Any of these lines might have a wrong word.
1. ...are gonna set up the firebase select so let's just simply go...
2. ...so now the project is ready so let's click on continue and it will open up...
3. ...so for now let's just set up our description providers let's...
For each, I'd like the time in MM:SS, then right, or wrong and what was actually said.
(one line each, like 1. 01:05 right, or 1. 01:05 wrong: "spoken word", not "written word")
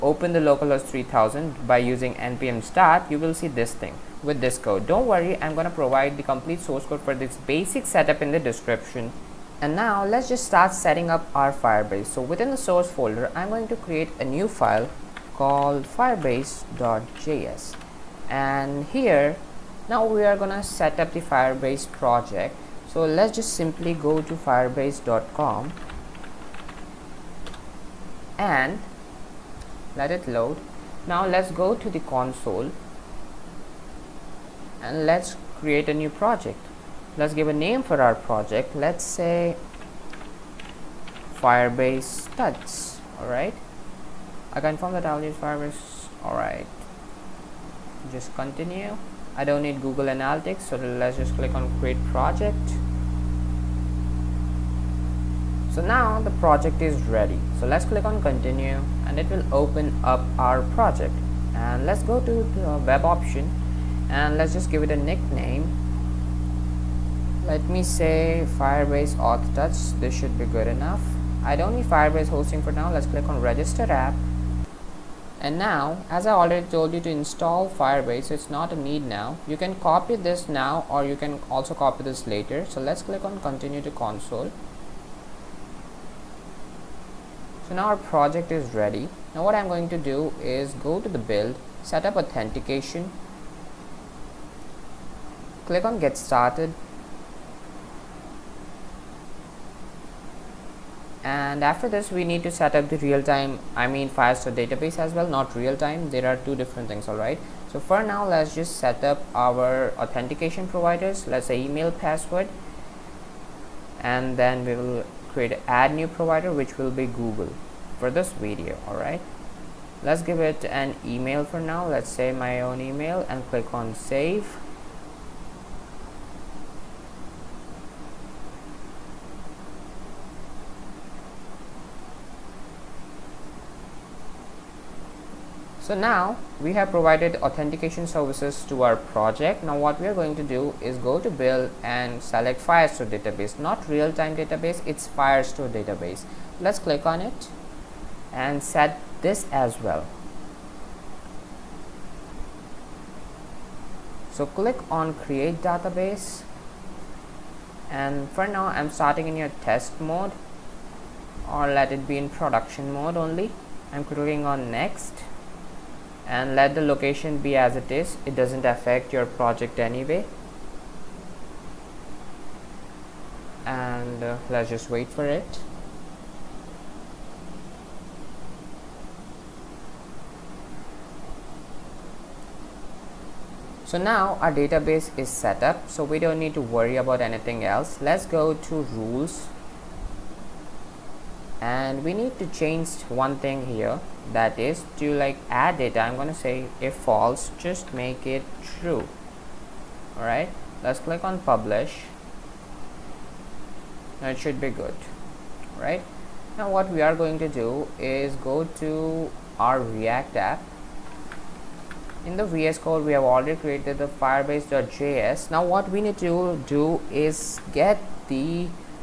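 1. 00:20 wrong: "project", not "select"
2. 00:55 right
3. 01:47 wrong: "authentication", not "description".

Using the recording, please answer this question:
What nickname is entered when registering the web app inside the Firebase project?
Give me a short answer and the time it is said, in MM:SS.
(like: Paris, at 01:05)
firebase auth touch, at 01:08.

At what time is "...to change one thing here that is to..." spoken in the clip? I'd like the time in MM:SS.
03:12.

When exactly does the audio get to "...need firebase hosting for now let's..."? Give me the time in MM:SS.
01:11.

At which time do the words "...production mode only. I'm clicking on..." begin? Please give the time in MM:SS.
02:42.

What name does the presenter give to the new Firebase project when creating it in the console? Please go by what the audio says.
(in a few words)
firebase tuts.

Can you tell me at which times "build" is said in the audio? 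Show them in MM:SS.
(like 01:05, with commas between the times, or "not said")
01:31, 02:21.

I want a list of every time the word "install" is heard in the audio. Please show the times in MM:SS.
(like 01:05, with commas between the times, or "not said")
01:17.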